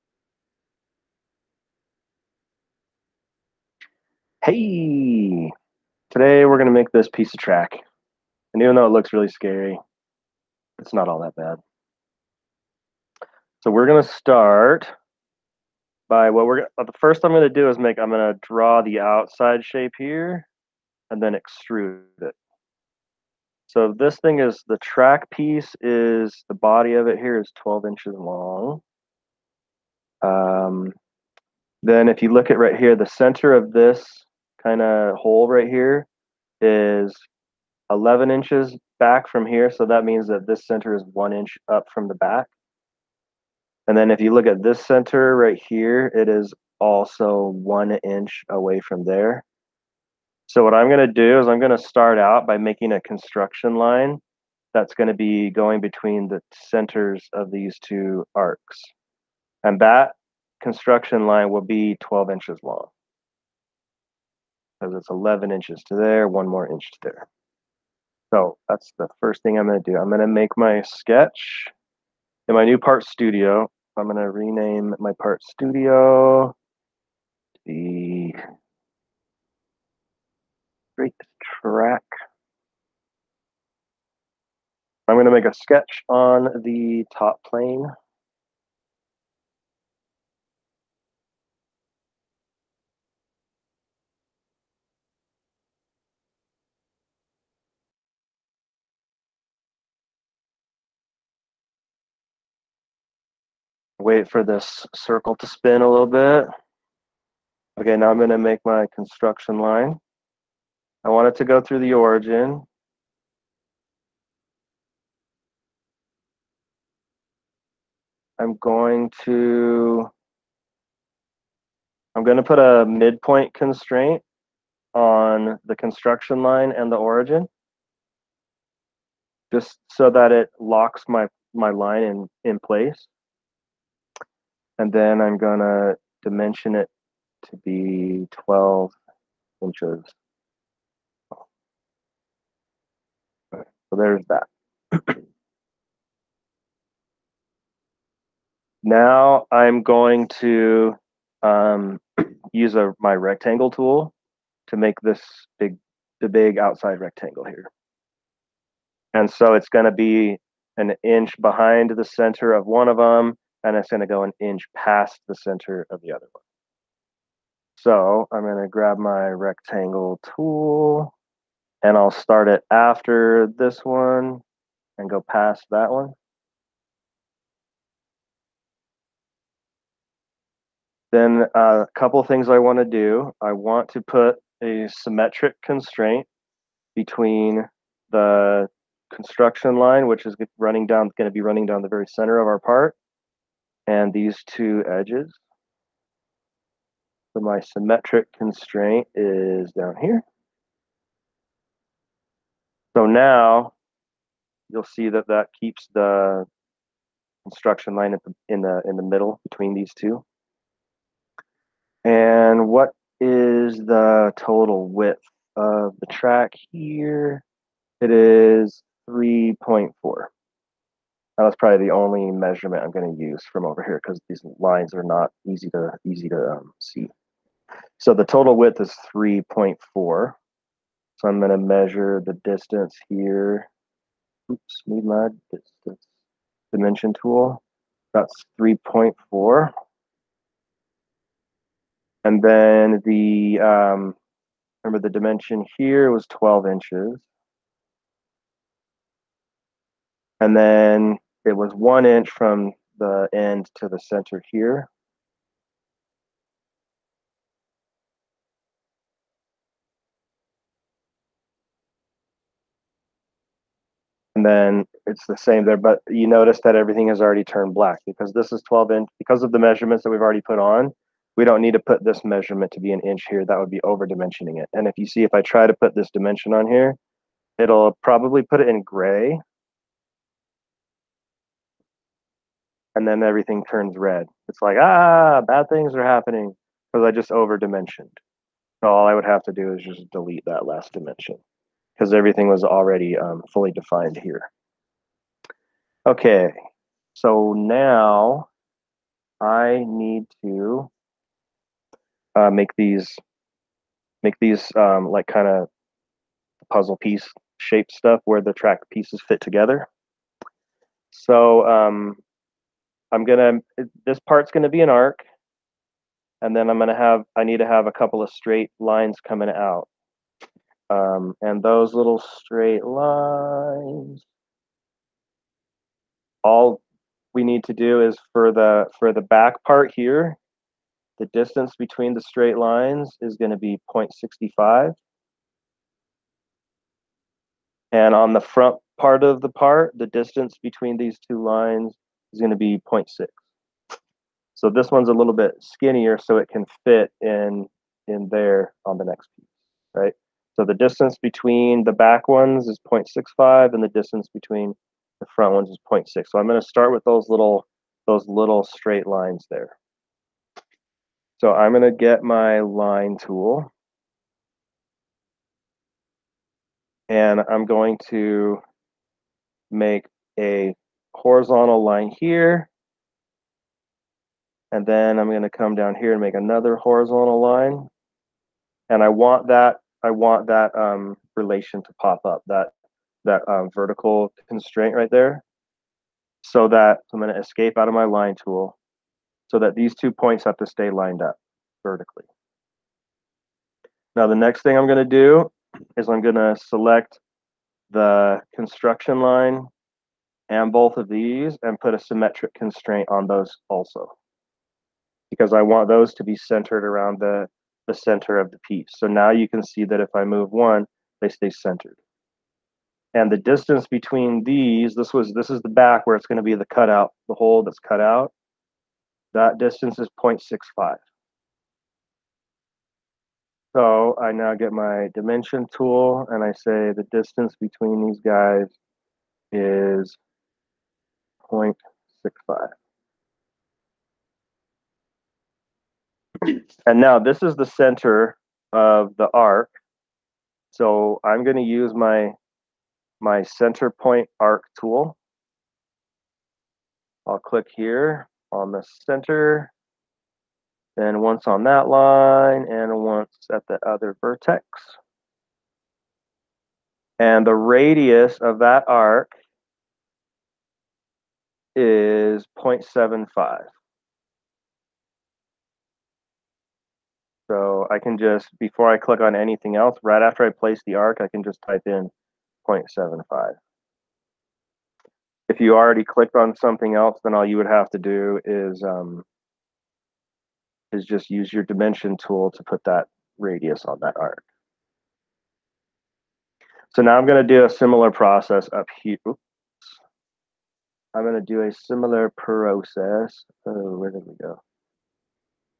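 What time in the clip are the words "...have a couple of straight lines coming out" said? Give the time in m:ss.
5:17.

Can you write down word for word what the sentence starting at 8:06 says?
So now I'm going to do a similar process up here.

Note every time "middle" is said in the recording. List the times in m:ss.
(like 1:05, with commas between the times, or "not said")
3:29.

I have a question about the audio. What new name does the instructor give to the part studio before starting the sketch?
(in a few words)
straight track.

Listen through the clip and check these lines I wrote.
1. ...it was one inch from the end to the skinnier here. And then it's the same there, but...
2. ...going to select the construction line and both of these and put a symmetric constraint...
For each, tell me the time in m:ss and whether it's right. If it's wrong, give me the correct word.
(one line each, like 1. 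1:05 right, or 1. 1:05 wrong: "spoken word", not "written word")
1. 4:11 wrong: "center", not "skinnier"
2. 6:36 right.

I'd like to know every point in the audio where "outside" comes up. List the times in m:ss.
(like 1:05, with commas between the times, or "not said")
0:19, 2:36.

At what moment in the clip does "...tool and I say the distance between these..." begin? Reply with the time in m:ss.
7:05.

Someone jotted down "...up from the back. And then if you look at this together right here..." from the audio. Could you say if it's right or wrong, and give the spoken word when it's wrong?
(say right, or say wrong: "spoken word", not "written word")
wrong: "center", not "together".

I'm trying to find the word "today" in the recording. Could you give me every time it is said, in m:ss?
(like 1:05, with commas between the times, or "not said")
0:06.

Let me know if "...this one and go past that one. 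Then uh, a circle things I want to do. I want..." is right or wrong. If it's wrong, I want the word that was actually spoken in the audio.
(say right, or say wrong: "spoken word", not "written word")
wrong: "couple", not "circle".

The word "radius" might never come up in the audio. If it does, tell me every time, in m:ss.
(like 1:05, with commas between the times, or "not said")
7:37, 8:03.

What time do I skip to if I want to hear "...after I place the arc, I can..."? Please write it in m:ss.
7:50.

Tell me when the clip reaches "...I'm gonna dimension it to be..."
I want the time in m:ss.
2:15.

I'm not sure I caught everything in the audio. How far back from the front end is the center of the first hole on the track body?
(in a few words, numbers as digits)
11 inches.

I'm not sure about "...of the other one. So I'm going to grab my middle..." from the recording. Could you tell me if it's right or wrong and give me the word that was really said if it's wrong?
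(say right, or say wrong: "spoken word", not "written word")
wrong: "rectangle", not "middle".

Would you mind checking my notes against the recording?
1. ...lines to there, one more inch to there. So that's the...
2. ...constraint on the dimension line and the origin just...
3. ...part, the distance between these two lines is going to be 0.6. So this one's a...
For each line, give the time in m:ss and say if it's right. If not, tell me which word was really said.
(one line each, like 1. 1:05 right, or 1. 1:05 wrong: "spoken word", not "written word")
1. 1:05 wrong: "inches", not "lines"
2. 2:03 wrong: "construction", not "dimension"
3. 5:39 right.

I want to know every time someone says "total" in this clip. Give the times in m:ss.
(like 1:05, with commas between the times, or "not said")
3:34, 3:48.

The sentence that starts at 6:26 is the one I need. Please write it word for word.
So that I'm going to escape out of my line tool so that these two points have to stay lined up vertically.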